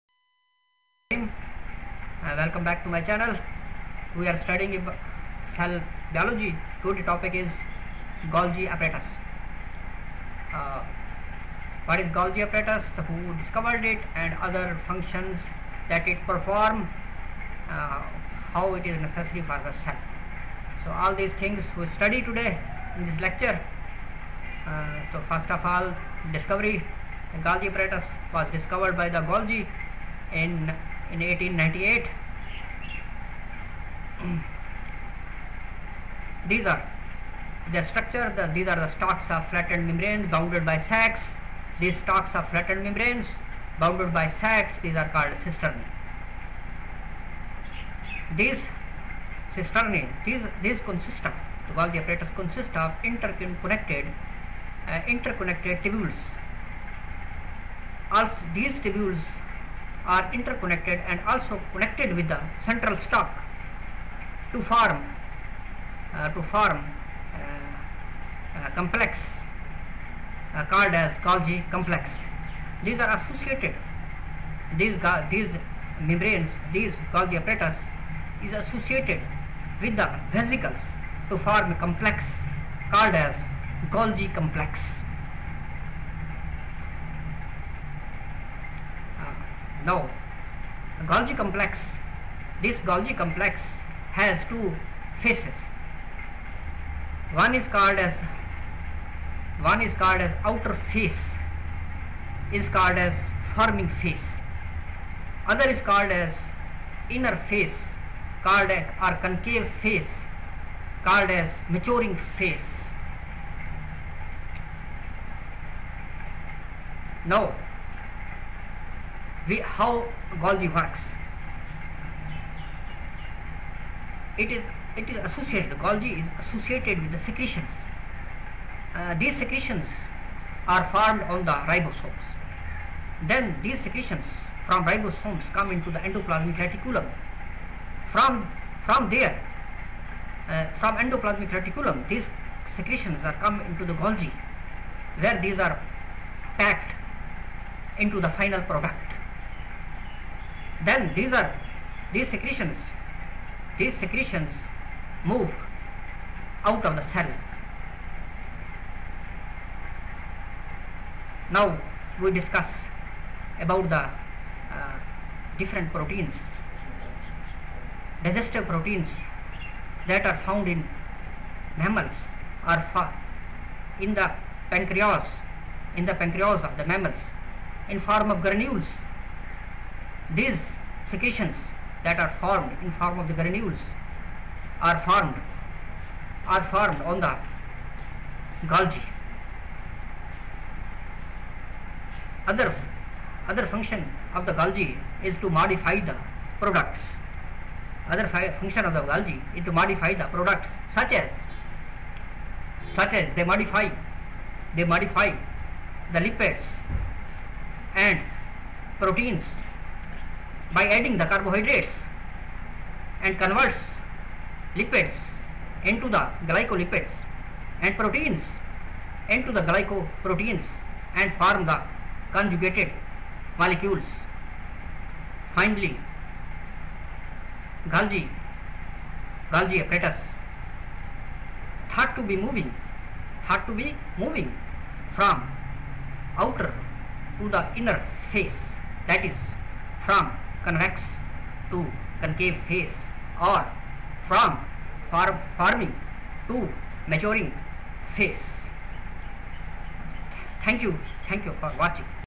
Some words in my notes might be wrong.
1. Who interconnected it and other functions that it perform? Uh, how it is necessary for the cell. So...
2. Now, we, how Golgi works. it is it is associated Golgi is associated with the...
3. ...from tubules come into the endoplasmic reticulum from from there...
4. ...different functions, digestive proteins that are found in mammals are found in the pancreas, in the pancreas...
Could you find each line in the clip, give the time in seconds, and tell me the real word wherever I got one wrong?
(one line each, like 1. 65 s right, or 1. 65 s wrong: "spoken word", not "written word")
1. 13 s wrong: "discovered", not "interconnected"
2. 117 s right
3. 134 s wrong: "ribosomes", not "tubules"
4. 165 s wrong: "proteins", not "functions".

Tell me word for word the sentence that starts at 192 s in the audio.
Other other function of the Golgi is to modify the products.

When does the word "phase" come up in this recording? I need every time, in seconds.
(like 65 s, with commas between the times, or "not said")
242 s, 248 s.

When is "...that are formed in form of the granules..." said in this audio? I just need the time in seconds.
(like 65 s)
182 s.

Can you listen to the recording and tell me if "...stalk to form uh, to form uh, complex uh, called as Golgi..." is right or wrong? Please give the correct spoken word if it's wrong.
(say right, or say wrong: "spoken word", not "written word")
right.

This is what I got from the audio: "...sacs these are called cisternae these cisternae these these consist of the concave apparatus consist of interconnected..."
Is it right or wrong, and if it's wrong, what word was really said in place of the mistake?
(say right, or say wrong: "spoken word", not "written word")
wrong: "valve", not "concave".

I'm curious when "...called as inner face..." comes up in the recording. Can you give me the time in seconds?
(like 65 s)
105 s.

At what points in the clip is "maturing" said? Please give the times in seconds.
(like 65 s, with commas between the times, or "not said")
111 s, 247 s.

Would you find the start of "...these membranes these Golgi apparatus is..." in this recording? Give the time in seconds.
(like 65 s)
75 s.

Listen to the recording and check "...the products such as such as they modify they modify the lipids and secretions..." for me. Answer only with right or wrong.
wrong.